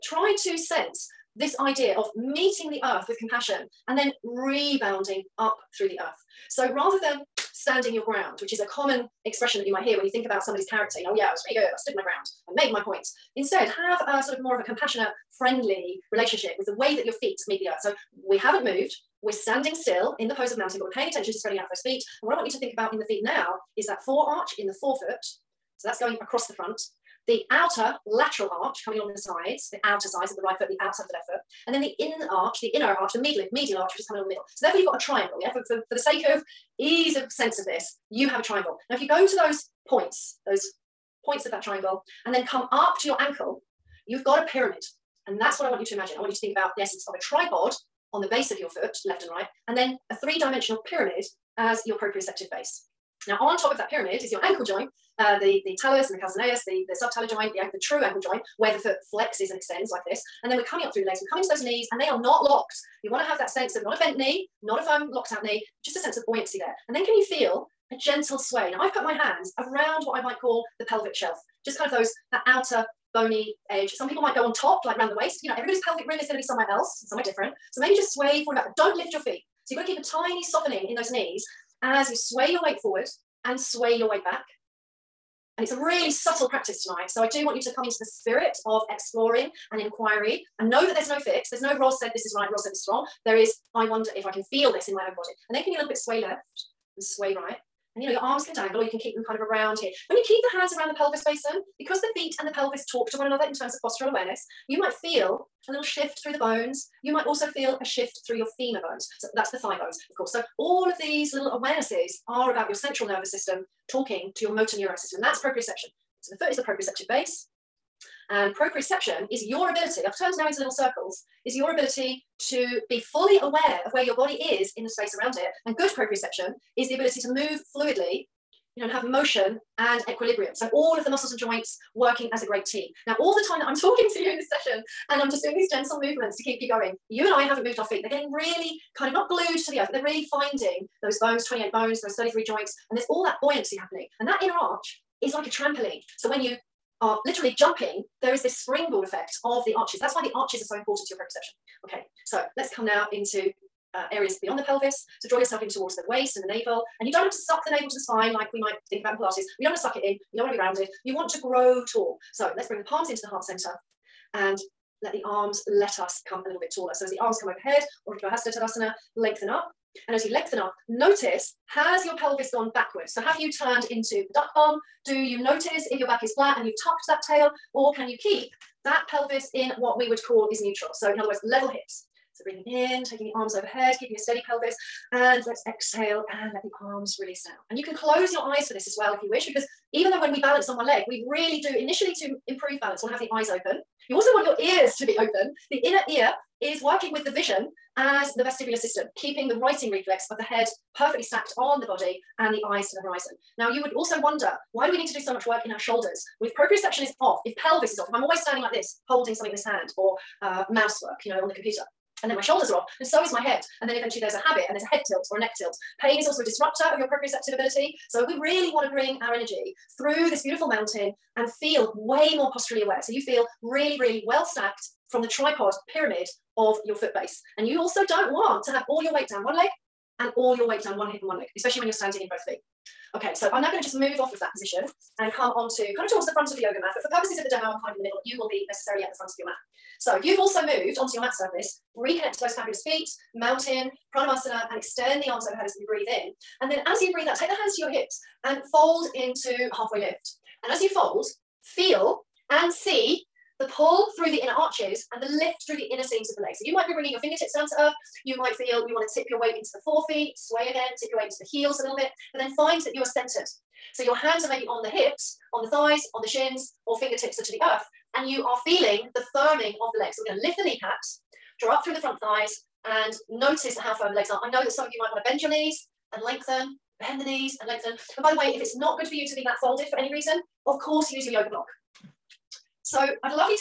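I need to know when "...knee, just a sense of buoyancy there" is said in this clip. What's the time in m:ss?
1:05.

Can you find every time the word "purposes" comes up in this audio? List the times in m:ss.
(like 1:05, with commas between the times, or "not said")
3:57.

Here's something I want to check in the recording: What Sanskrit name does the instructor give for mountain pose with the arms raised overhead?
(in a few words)
Urdhva Hasta Tadasana.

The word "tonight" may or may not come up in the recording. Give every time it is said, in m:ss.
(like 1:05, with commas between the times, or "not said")
1:26.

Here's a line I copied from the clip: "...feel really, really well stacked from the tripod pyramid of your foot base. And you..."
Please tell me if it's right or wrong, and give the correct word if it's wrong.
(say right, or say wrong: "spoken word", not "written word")
right.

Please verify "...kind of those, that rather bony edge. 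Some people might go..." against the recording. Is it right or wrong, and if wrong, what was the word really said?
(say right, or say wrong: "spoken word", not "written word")
wrong: "outer", not "rather".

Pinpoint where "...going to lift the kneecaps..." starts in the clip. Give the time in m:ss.
4:30.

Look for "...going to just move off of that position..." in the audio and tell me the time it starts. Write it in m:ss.
3:53.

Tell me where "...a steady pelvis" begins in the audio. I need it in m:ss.
3:04.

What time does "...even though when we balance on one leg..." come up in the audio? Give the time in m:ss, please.
3:09.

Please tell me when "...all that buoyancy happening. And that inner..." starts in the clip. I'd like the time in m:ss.
2:23.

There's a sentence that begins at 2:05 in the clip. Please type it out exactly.
And good proprioception is the ability to move fluidly, you know, and have motion and equilibrium.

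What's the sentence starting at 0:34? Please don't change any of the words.
So therefore you've got a triangle, yeah?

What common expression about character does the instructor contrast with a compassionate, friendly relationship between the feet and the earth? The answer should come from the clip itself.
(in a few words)
Standing your ground.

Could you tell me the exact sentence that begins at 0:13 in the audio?
Instead, have a sort of more of a compassionate, friendly relationship with the way that your feet meet the earth.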